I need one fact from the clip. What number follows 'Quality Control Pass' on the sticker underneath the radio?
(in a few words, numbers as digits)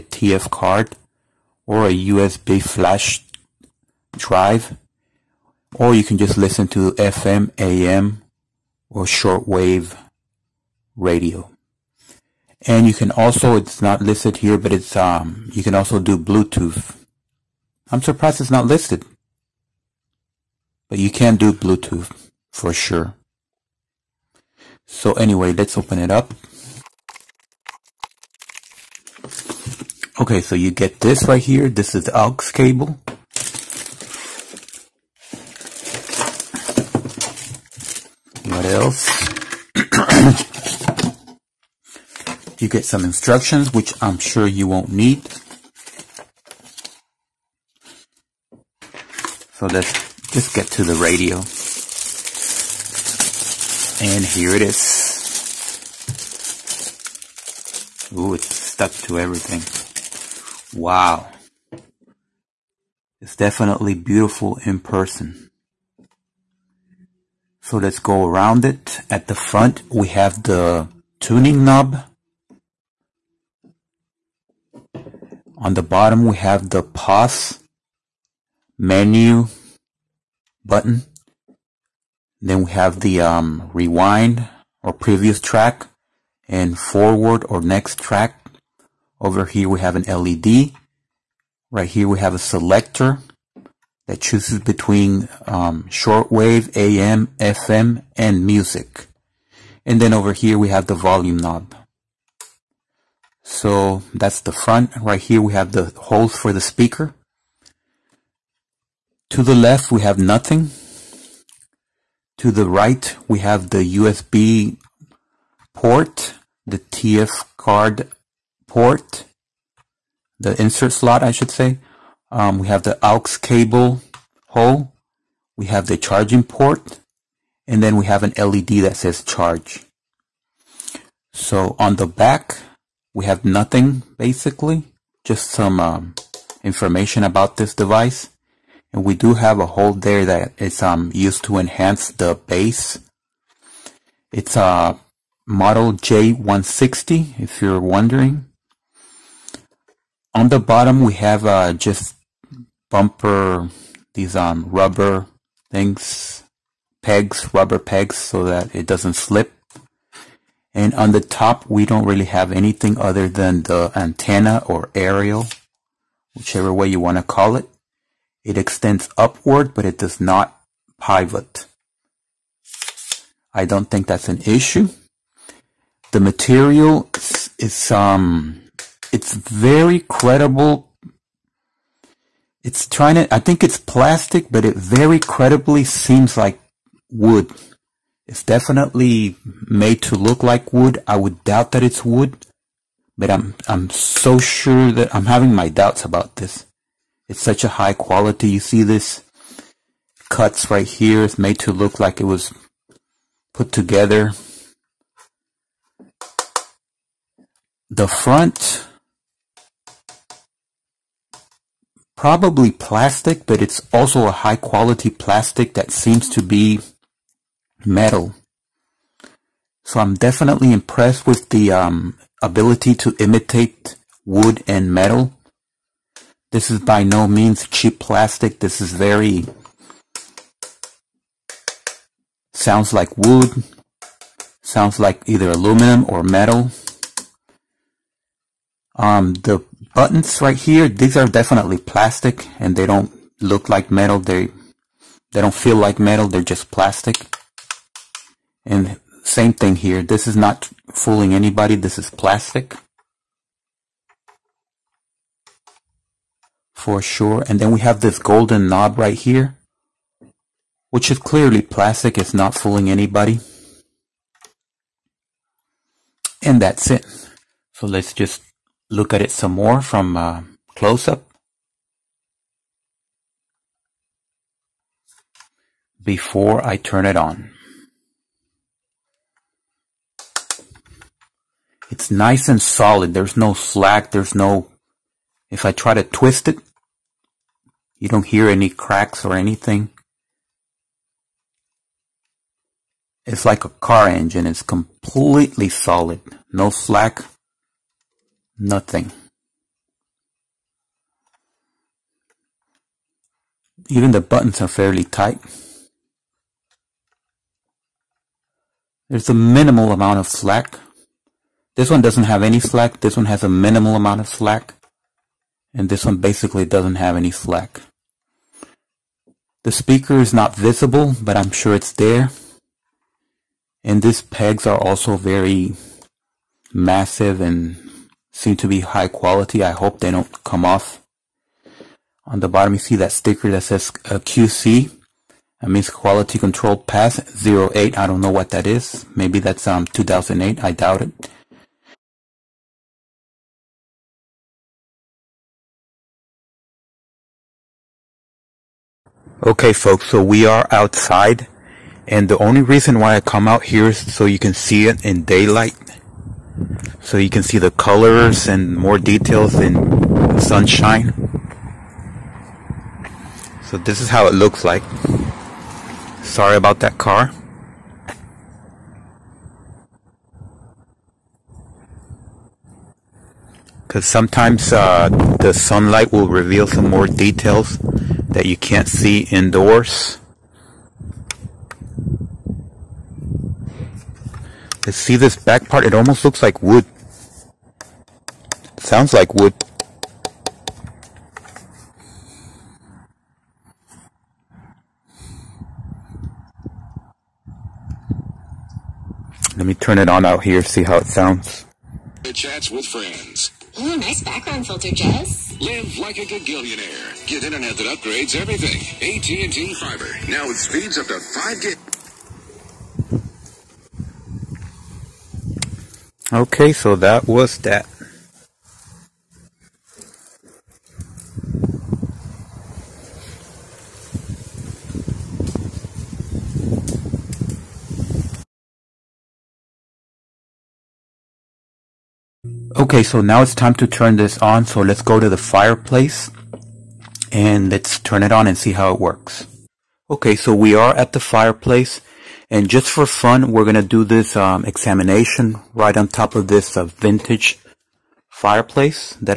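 08.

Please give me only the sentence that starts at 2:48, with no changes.
It extends upward, but it does not pivot.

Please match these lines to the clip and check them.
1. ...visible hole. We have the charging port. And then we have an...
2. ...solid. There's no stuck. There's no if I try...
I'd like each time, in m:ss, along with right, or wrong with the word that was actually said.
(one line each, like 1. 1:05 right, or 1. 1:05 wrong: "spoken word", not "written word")
1. 2:03 wrong: "cable", not "visible"
2. 4:42 wrong: "slack", not "stuck".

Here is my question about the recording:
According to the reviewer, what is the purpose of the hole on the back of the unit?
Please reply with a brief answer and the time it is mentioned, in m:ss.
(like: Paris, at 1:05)
To enhance the bass, at 2:21.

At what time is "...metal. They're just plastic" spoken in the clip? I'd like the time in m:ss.
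4:05.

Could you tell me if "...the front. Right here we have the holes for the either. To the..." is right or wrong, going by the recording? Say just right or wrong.
wrong.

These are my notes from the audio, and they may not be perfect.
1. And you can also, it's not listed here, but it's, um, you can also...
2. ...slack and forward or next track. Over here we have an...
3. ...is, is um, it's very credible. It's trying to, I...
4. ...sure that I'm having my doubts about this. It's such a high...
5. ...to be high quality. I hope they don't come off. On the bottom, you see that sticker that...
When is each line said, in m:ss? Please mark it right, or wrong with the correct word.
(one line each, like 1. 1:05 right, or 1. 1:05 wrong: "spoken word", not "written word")
1. 0:12 right
2. 1:25 wrong: "track", not "slack"
3. 2:57 right
4. 3:14 right
5. 5:28 right.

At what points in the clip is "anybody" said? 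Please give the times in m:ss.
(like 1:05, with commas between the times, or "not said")
4:11, 4:22.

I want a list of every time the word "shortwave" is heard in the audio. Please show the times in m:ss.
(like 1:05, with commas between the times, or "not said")
0:09, 1:35.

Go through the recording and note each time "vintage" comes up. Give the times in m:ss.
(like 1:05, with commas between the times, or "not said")
7:26.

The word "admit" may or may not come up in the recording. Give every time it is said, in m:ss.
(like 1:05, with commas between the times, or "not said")
not said.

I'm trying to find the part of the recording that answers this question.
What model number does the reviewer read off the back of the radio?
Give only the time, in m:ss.
2:25.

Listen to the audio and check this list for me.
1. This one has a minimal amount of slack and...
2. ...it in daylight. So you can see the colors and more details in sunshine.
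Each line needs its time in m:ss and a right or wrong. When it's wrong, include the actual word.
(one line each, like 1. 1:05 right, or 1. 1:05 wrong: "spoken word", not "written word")
1. 5:13 right
2. 5:54 right.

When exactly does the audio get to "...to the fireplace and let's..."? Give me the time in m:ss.
7:15.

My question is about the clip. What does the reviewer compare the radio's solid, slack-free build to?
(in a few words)
A car engine.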